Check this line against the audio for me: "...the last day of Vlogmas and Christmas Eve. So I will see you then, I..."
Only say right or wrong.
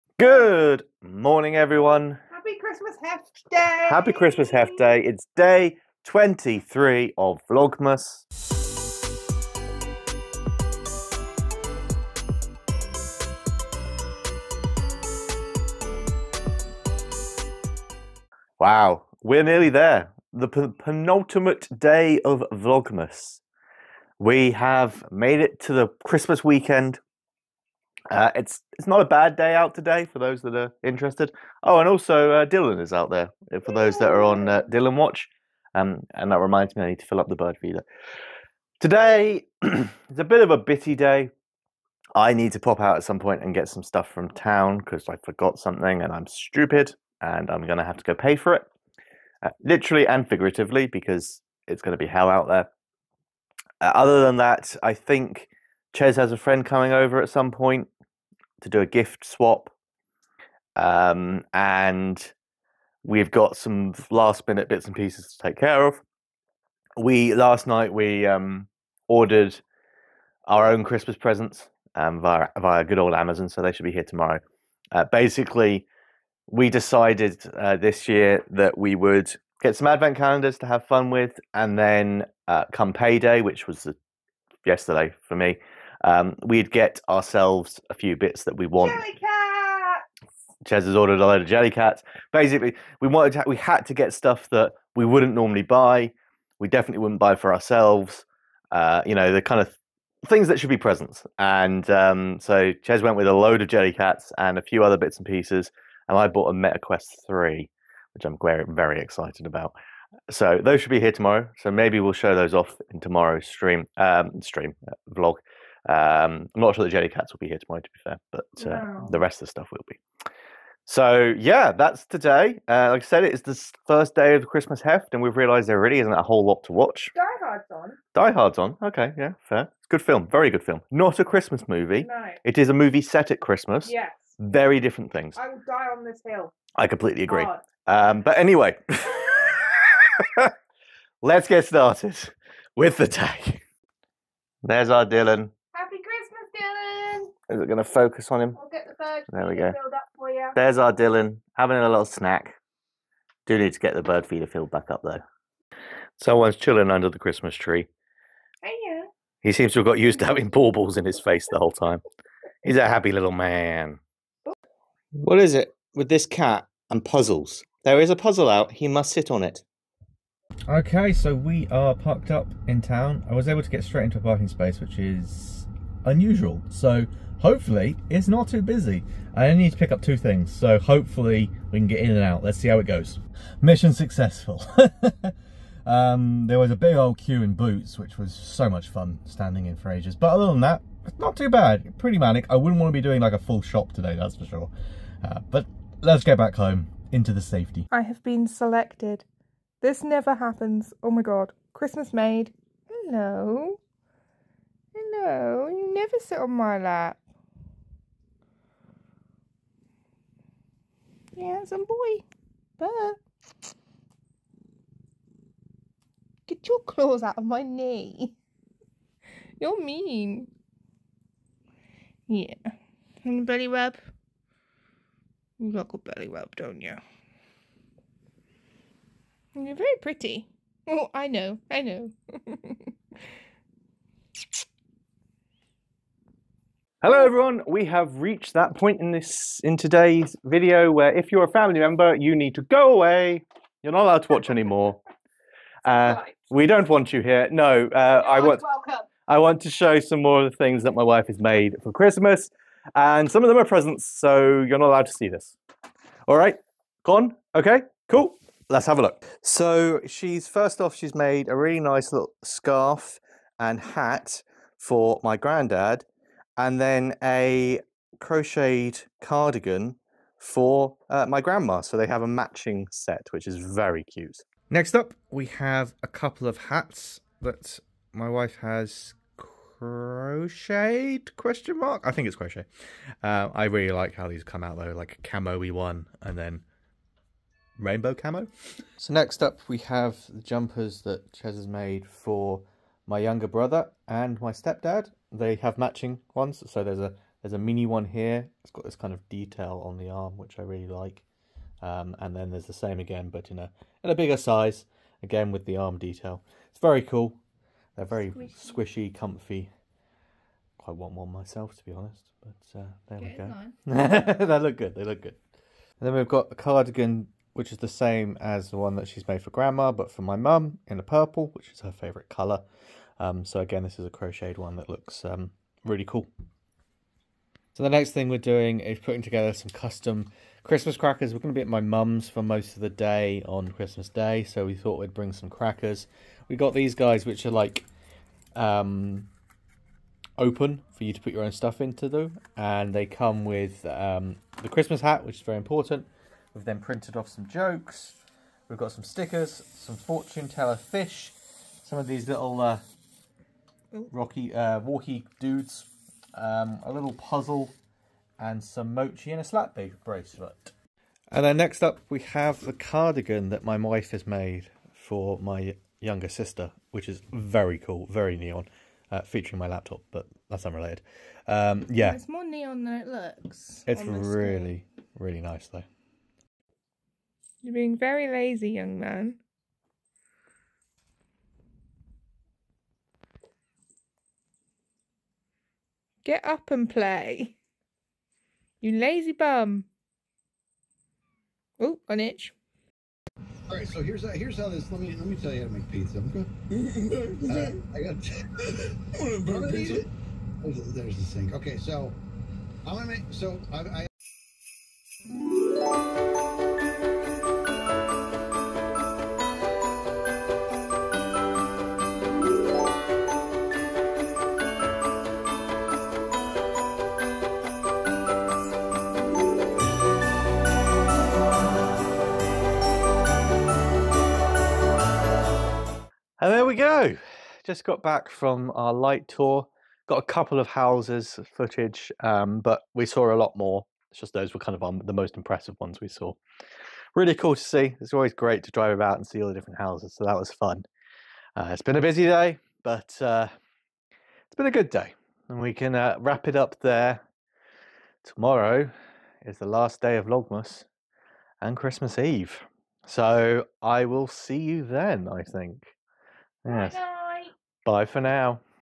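right.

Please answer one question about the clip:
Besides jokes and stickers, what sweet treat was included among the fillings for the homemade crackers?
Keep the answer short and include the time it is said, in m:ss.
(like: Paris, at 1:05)
Mochi, at 5:58.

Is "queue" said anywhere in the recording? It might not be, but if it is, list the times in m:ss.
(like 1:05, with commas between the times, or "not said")
3:07.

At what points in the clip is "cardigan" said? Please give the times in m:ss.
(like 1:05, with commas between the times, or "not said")
4:29, 5:16, 6:02.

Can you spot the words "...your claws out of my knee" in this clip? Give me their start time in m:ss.
3:36.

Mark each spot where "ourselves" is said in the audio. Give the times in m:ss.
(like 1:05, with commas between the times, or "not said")
1:27, 1:37.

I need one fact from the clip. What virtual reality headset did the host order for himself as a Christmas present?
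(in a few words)
MetaQuest 3.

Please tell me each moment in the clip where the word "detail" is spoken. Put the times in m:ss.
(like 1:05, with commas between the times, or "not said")
4:59, 5:05.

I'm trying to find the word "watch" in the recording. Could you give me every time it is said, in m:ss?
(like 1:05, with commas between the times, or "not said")
0:34, 2:06, 4:04.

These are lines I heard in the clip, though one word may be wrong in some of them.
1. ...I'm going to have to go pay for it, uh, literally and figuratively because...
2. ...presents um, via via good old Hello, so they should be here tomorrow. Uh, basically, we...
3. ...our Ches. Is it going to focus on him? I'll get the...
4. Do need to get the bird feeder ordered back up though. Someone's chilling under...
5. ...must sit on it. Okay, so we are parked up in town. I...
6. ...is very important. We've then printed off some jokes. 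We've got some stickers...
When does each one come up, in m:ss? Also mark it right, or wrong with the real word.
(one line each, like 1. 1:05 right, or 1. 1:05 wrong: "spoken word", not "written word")
1. 0:47 right
2. 1:11 wrong: "Amazon", not "Hello"
3. 2:24 wrong: "Dylan", not "Ches"
4. 2:33 wrong: "filled", not "ordered"
5. 2:48 right
6. 5:45 right.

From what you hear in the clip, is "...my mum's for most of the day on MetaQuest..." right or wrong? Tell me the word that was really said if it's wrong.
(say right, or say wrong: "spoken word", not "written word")
wrong: "Christmas", not "MetaQuest".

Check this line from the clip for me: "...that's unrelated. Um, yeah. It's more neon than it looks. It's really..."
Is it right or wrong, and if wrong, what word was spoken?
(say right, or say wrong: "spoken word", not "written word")
right.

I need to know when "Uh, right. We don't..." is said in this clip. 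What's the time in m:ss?
4:05.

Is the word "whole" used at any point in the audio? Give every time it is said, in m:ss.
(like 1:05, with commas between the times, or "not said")
2:06, 2:41.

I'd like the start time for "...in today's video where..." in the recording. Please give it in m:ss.
3:59.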